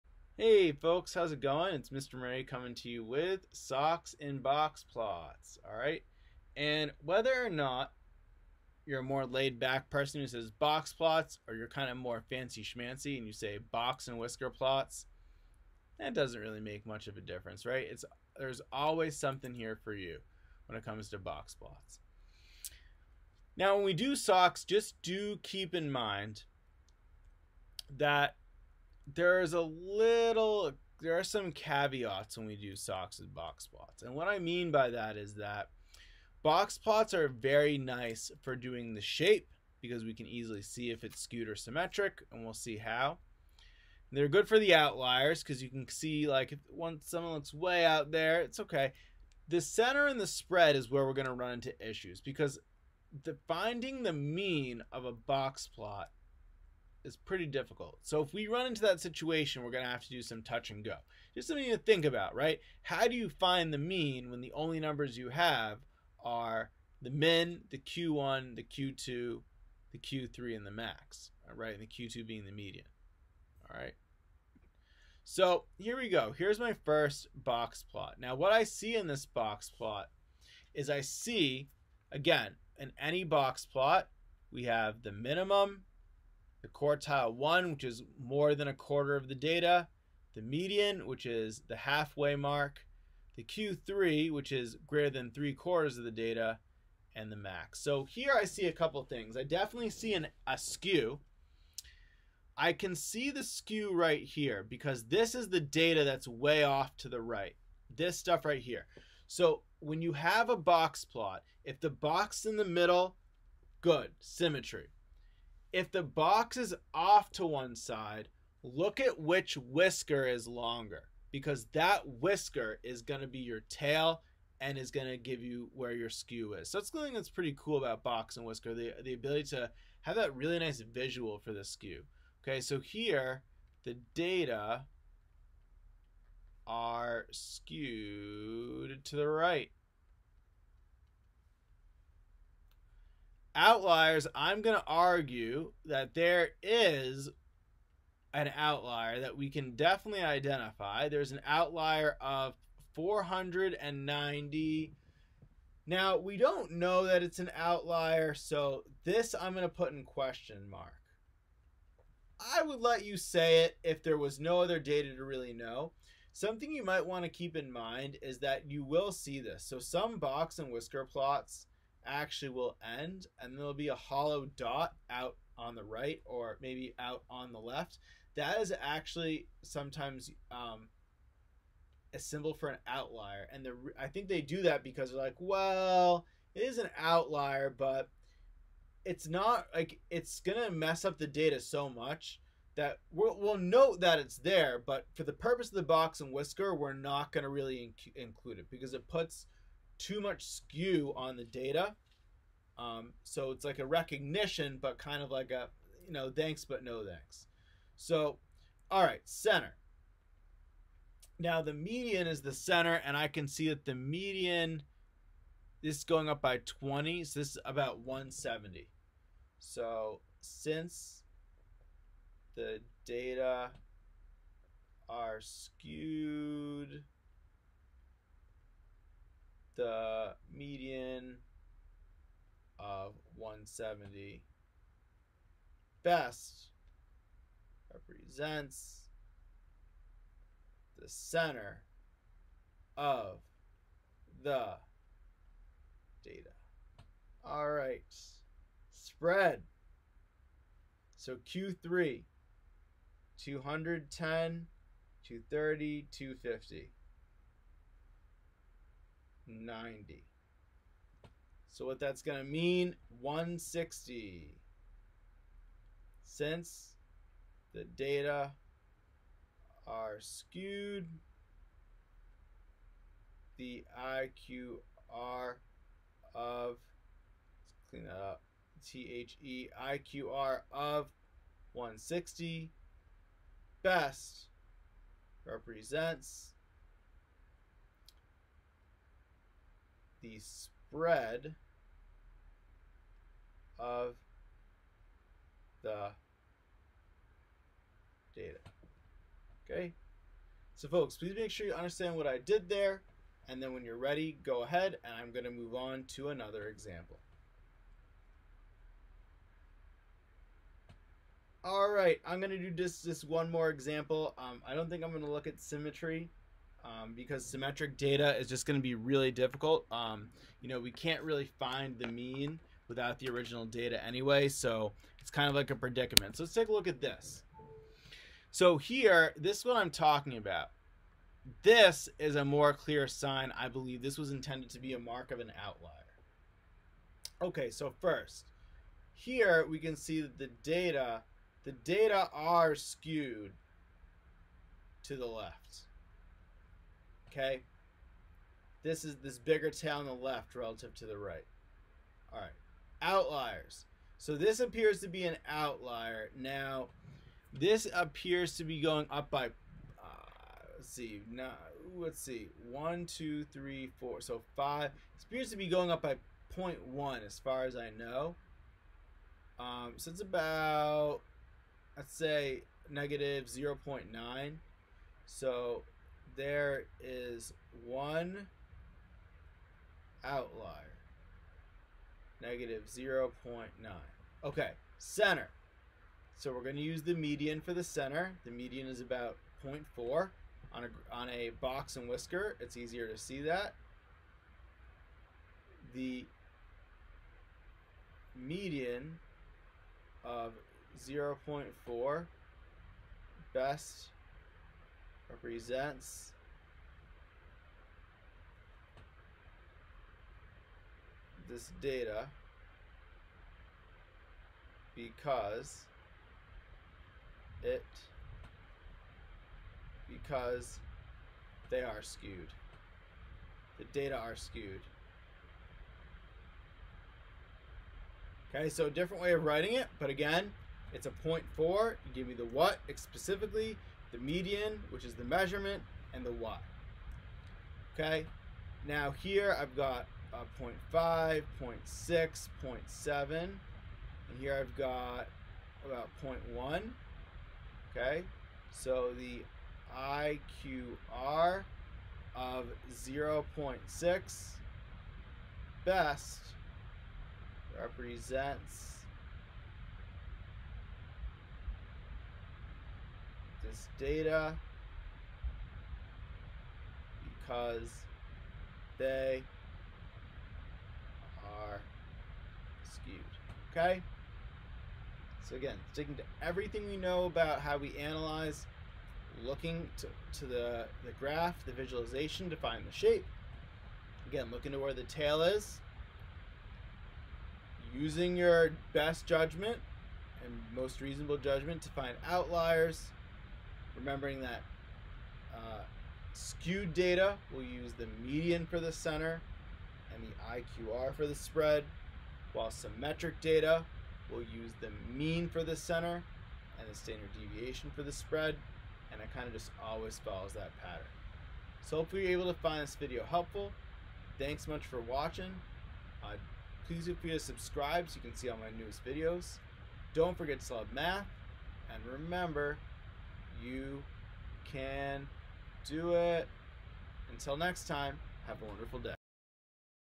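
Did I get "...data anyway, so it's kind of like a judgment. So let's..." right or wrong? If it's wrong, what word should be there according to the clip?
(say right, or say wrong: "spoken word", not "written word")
wrong: "predicament", not "judgment".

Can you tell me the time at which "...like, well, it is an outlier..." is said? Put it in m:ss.
3:05.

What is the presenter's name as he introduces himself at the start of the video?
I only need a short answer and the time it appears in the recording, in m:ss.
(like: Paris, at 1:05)
Mr. Moray, at 0:01.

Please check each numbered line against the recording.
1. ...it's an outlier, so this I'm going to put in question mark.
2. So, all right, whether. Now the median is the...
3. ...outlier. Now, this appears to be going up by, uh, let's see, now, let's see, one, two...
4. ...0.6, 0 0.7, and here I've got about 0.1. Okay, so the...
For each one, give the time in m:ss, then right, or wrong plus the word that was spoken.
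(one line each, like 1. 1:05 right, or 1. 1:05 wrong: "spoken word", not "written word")
1. 2:37 right
2. 3:27 wrong: "center", not "whether"
3. 5:55 right
4. 7:21 right.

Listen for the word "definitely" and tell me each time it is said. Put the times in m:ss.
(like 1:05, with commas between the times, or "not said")
1:39, 2:29.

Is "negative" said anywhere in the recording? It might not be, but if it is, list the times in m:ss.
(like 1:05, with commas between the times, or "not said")
6:12, 6:22.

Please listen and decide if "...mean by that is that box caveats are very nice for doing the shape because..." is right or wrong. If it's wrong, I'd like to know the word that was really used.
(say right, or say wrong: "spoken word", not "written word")
wrong: "plots", not "caveats".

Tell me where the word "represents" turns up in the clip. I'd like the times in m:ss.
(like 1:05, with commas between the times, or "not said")
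3:57, 4:45, 6:45, 7:37.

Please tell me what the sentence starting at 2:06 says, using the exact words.
So that's something that's pretty cool about box and whisker, the, the ability to have that really nice visual for the skew.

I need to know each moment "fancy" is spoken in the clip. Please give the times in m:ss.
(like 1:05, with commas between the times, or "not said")
0:12.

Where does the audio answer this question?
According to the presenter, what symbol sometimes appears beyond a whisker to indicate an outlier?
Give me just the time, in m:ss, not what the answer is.
2:53.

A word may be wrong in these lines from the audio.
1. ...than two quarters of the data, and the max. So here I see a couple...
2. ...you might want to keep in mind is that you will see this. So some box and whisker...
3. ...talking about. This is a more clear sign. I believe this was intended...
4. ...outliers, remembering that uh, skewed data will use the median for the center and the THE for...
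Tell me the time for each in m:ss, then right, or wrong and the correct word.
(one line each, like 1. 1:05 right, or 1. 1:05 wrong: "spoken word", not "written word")
1. 1:35 wrong: "three", not "two"
2. 2:46 right
3. 5:29 right
4. 8:12 wrong: "IQR", not "THE".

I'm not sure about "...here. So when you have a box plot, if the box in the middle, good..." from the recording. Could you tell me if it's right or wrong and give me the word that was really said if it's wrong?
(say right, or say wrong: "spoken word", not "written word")
right.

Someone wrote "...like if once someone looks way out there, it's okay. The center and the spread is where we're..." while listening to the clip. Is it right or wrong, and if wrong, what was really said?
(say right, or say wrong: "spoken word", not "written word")
right.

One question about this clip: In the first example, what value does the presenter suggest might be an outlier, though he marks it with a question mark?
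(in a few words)
490.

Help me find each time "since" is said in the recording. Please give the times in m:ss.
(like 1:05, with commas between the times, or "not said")
3:40, 4:26.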